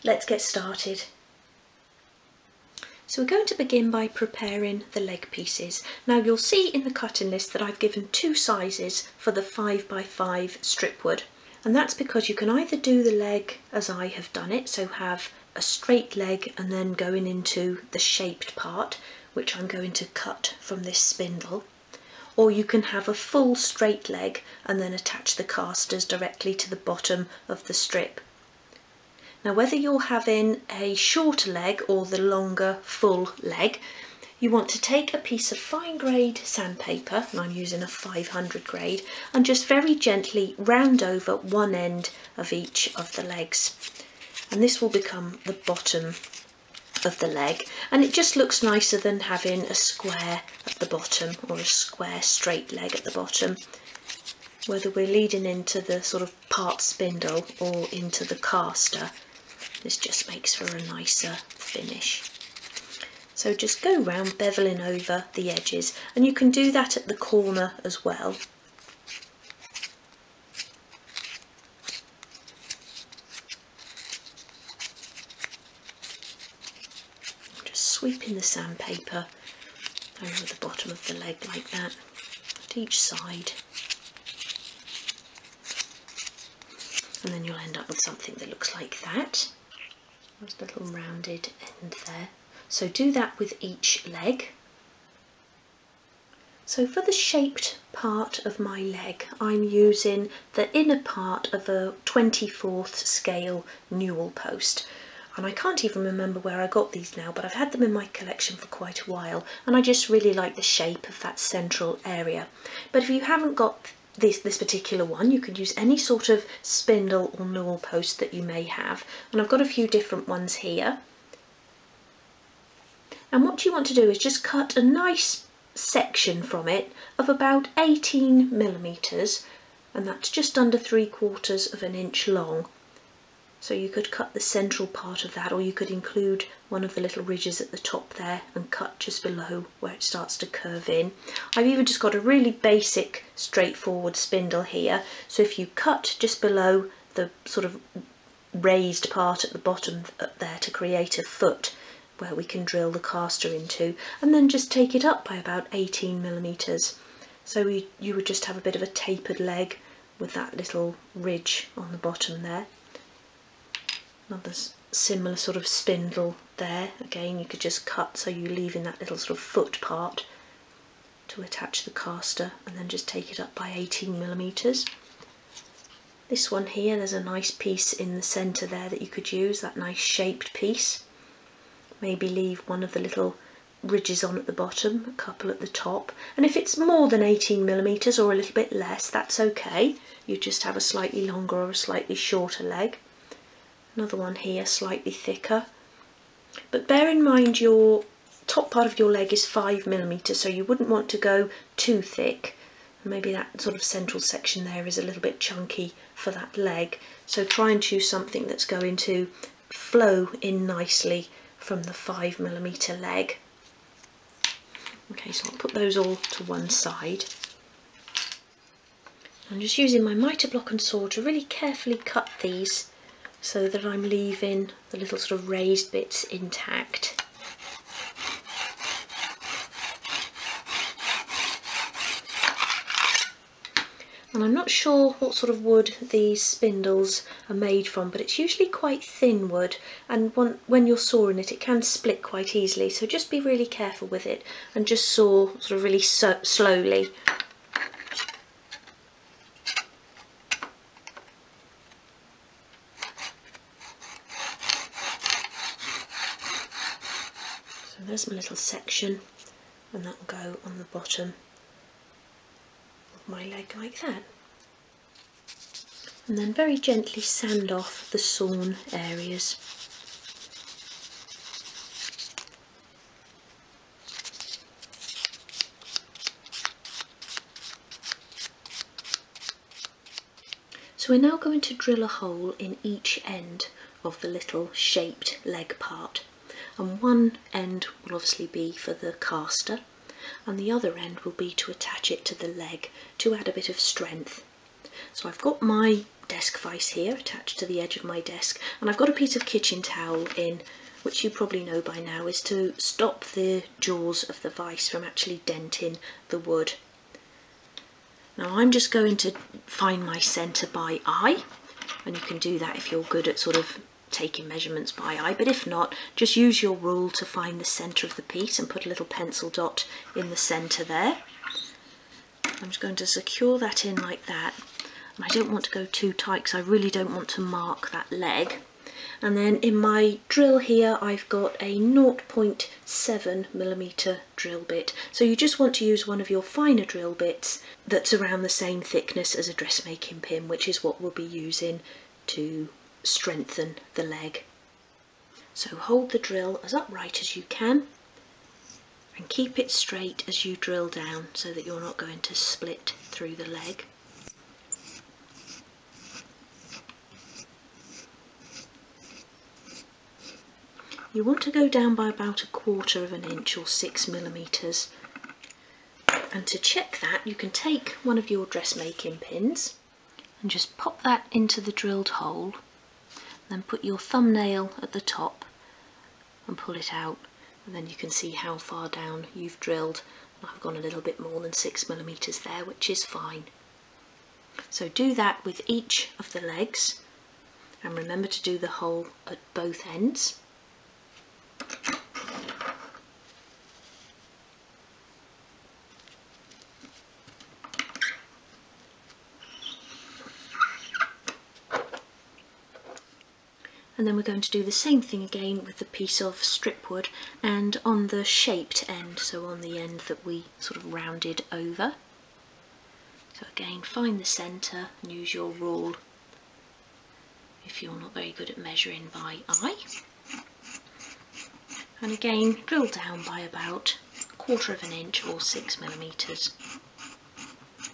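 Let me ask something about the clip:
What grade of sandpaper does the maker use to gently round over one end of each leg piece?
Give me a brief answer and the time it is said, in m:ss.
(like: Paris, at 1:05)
500, at 0:37.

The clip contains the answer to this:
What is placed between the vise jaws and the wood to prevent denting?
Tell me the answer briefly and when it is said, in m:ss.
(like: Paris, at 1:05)
kitchen towel, at 4:59.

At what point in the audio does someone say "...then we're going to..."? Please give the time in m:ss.
6:44.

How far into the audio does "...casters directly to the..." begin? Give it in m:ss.
0:25.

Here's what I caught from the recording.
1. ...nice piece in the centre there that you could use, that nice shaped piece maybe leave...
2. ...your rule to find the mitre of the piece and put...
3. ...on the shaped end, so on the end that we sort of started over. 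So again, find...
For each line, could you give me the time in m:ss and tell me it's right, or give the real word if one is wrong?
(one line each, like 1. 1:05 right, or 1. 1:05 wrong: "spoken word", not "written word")
1. 2:57 right
2. 5:16 wrong: "centre", not "mitre"
3. 6:47 wrong: "rounded", not "started".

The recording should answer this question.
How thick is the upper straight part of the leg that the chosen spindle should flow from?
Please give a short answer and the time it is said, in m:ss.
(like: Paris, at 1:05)
5 millimetres, at 3:19.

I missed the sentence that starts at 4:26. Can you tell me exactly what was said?
And then very gently sand off the sawn areas.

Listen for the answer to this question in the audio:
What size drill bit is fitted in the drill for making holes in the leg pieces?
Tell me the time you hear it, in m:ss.
5:31.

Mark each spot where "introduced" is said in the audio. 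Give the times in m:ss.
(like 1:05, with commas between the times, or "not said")
not said.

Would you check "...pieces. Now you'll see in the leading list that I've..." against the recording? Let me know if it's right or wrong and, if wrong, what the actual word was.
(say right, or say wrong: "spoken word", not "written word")
wrong: "cutting", not "leading".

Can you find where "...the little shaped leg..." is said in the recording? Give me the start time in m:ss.
4:44.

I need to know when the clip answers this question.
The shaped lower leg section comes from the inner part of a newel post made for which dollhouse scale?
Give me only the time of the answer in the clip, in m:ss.
1:42.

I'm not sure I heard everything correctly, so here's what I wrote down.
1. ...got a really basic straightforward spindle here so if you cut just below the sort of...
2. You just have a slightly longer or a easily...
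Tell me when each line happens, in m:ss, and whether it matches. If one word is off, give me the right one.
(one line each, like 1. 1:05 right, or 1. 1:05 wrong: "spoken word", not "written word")
1. 2:21 right
2. 3:10 wrong: "slightly", not "easily".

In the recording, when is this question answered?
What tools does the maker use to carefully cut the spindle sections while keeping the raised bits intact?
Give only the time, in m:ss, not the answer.
3:40.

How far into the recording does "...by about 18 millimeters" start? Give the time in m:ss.
2:35.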